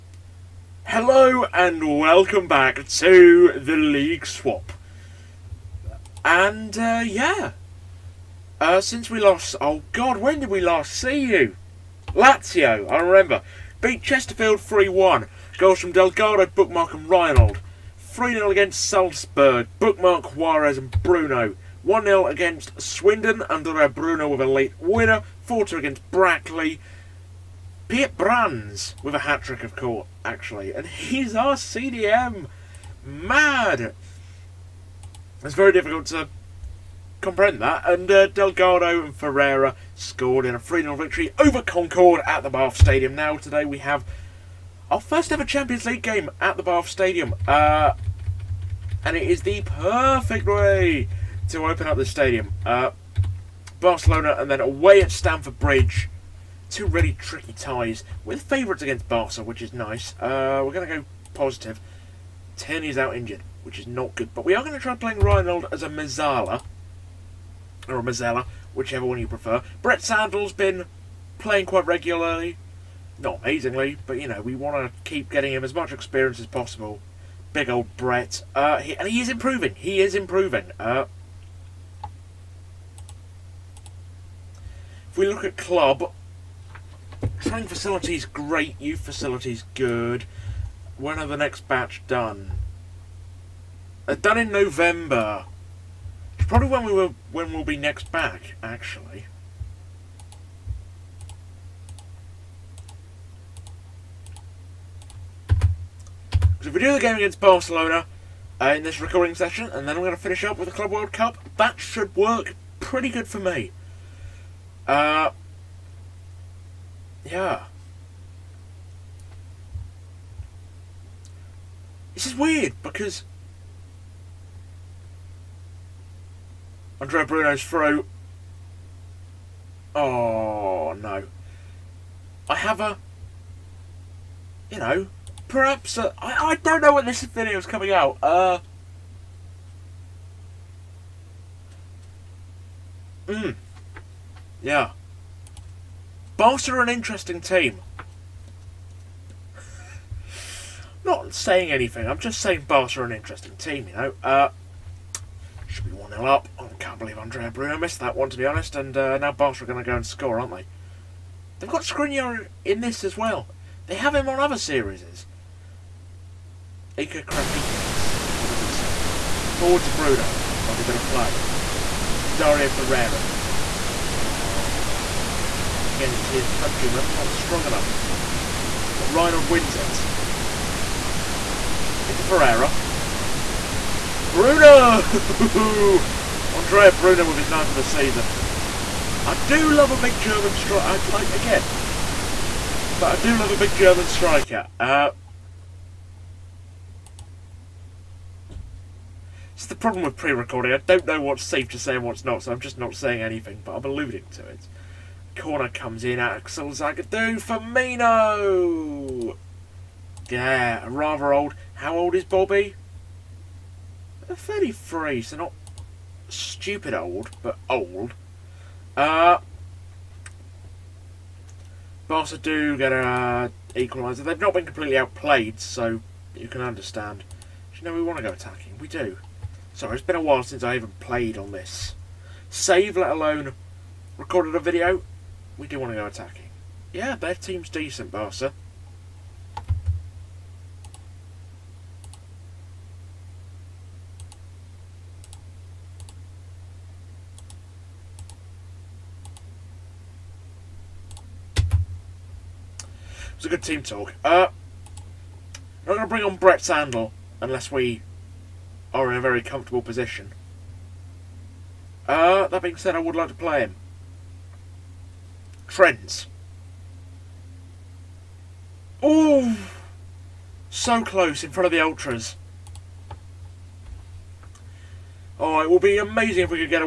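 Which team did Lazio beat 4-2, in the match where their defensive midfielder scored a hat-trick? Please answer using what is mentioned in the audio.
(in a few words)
Brackley.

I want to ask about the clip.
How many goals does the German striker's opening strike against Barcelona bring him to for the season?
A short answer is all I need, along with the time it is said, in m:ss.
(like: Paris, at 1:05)
9, at 3:07.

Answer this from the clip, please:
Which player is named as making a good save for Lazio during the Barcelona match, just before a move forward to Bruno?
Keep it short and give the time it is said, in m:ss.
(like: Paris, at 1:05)
Ika Krapikas, at 2:46.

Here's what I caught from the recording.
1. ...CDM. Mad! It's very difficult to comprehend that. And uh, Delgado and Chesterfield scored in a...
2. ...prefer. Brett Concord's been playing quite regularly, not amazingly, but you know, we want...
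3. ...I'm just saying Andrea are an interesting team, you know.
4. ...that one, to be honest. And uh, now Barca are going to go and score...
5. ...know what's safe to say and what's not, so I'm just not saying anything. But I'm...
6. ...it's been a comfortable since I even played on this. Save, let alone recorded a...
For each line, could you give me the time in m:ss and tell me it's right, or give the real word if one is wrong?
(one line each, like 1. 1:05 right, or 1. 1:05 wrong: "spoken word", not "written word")
1. 0:31 wrong: "Ferreira", not "Chesterfield"
2. 1:09 wrong: "Sandel", not "Concord"
3. 2:32 wrong: "Barca", not "Andrea"
4. 2:37 right
5. 3:21 right
6. 3:49 wrong: "while", not "comfortable".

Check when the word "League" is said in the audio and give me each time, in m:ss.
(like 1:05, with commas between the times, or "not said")
0:03, 0:45.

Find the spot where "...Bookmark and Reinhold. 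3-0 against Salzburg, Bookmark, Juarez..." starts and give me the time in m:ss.
0:16.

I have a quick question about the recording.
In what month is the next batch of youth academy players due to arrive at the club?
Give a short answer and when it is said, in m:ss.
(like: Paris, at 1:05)
November, at 1:34.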